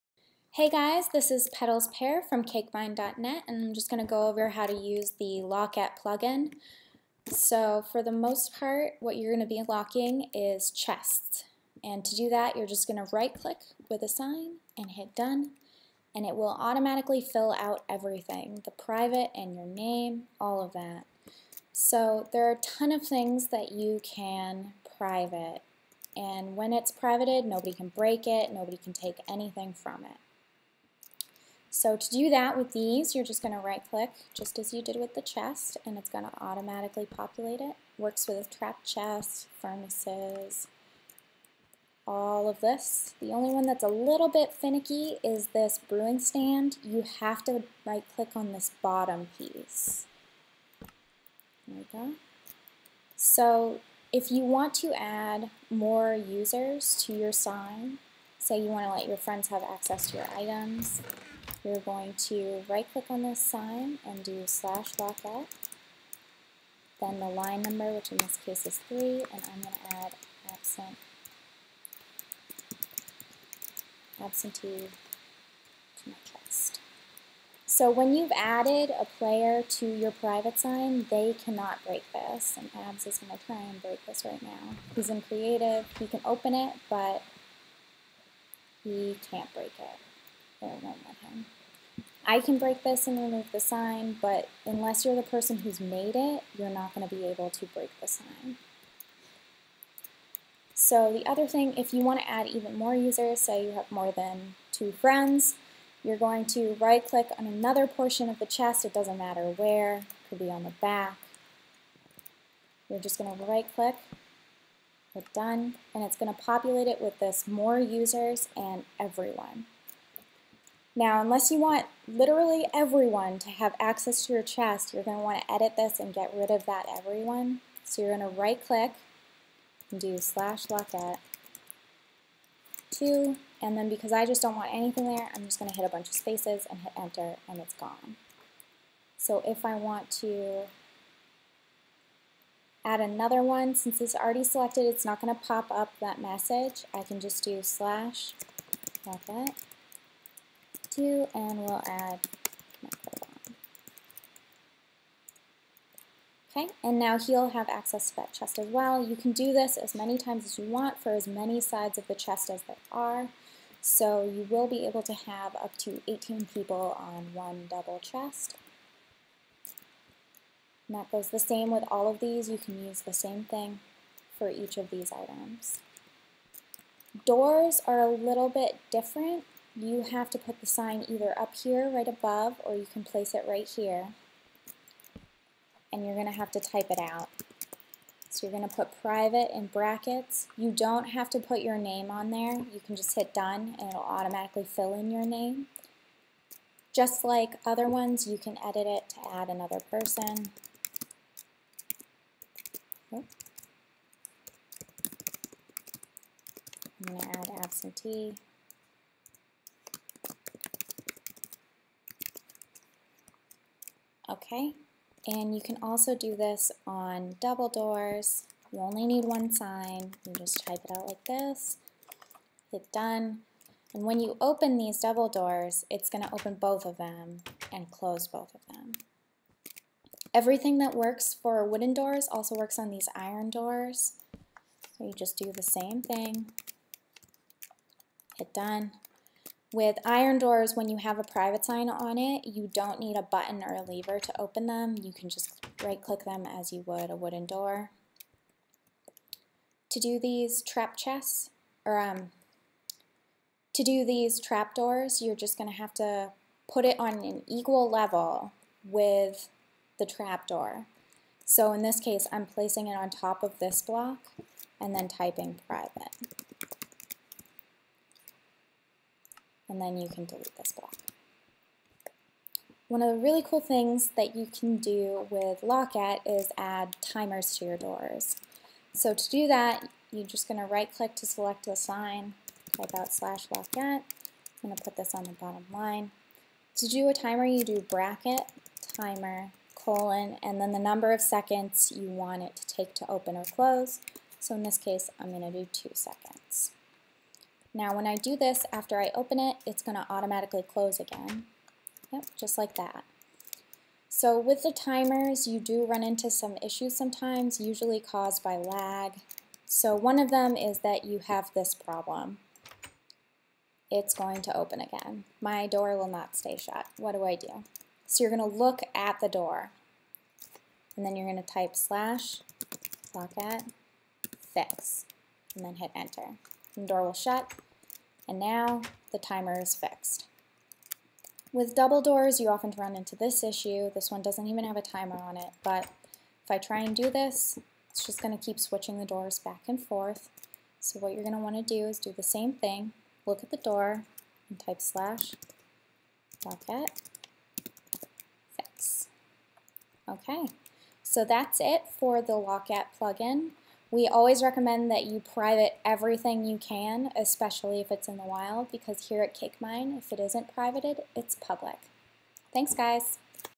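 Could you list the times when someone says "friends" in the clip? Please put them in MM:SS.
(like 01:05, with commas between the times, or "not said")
00:59, 01:44.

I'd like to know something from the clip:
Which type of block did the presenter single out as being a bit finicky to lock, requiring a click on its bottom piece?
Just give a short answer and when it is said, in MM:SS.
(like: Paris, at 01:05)
Brewing stand, at 00:45.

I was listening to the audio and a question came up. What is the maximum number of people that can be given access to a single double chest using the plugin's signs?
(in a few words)
18.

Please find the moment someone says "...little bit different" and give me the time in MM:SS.
02:58.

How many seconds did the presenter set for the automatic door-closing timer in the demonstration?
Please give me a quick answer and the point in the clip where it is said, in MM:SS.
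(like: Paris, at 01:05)
2, at 04:55.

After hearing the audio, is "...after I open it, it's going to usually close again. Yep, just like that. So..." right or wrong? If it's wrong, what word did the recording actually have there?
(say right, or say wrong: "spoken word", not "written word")
wrong: "automatically", not "usually".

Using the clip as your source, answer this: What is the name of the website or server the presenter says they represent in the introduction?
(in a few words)
CakeMine.net.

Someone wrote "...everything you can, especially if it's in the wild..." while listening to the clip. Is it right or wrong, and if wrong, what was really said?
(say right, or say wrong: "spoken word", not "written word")
right.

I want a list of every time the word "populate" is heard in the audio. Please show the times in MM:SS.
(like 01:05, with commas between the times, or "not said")
00:37, 01:56.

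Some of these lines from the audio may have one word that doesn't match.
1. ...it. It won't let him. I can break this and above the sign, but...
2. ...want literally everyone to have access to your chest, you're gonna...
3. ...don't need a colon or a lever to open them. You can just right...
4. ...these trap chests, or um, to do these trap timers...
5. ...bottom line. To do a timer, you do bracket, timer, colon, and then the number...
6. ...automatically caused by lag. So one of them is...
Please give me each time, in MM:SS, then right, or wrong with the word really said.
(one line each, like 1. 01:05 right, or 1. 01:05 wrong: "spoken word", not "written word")
1. 01:29 wrong: "remove", not "above"
2. 02:01 right
3. 04:02 wrong: "button", not "colon"
4. 04:10 wrong: "doors", not "timers"
5. 04:45 right
6. 05:07 wrong: "usually", not "automatically".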